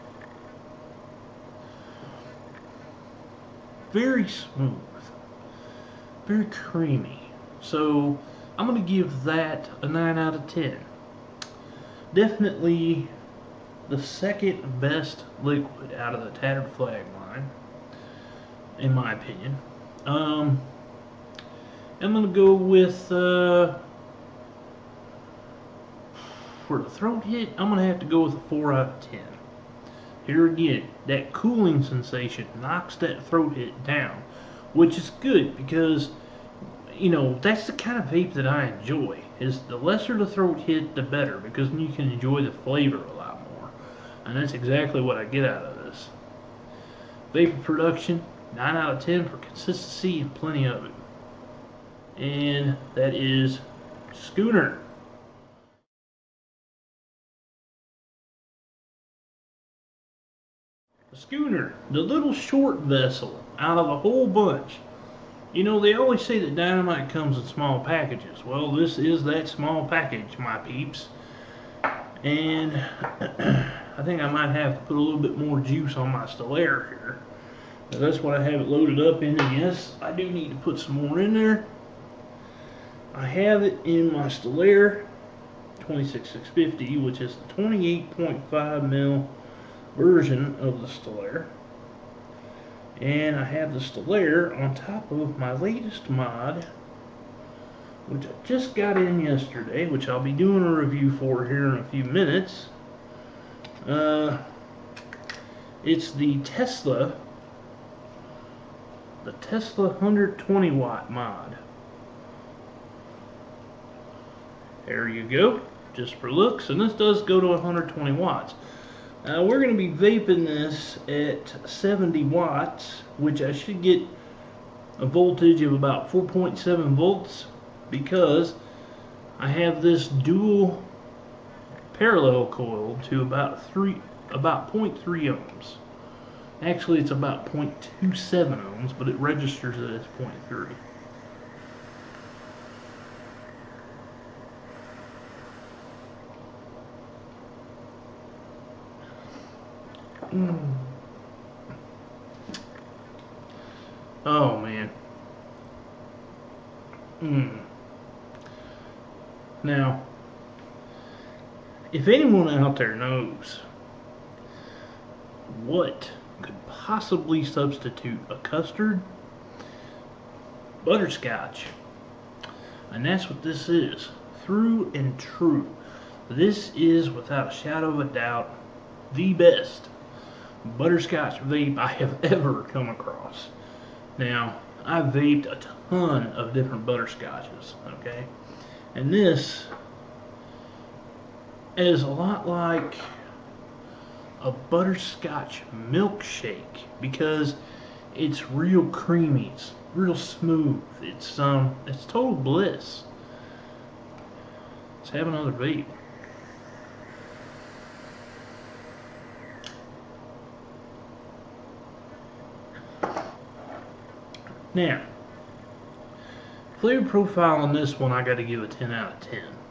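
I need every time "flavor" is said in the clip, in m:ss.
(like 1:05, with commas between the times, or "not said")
0:42, 3:36.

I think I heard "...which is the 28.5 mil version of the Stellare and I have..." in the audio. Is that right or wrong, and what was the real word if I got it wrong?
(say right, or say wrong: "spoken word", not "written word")
right.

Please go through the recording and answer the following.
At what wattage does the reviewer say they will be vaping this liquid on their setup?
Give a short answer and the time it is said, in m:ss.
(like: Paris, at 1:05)
70 watts, at 2:01.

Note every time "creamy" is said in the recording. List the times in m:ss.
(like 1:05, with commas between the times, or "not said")
0:06, 3:18.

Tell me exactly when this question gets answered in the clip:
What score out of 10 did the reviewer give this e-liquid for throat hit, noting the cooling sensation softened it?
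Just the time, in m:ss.
0:28.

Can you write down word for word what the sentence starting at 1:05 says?
You know, they always say that dynamite comes in small packages.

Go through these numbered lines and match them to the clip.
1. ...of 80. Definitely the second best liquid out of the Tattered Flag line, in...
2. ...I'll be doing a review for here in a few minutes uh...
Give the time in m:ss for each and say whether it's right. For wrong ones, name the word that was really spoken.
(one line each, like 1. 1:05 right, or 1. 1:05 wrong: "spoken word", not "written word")
1. 0:10 wrong: "10", not "80"
2. 1:40 right.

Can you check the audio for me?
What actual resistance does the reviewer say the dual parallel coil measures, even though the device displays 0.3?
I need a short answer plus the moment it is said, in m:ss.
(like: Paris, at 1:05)
0.27 ohms, at 2:17.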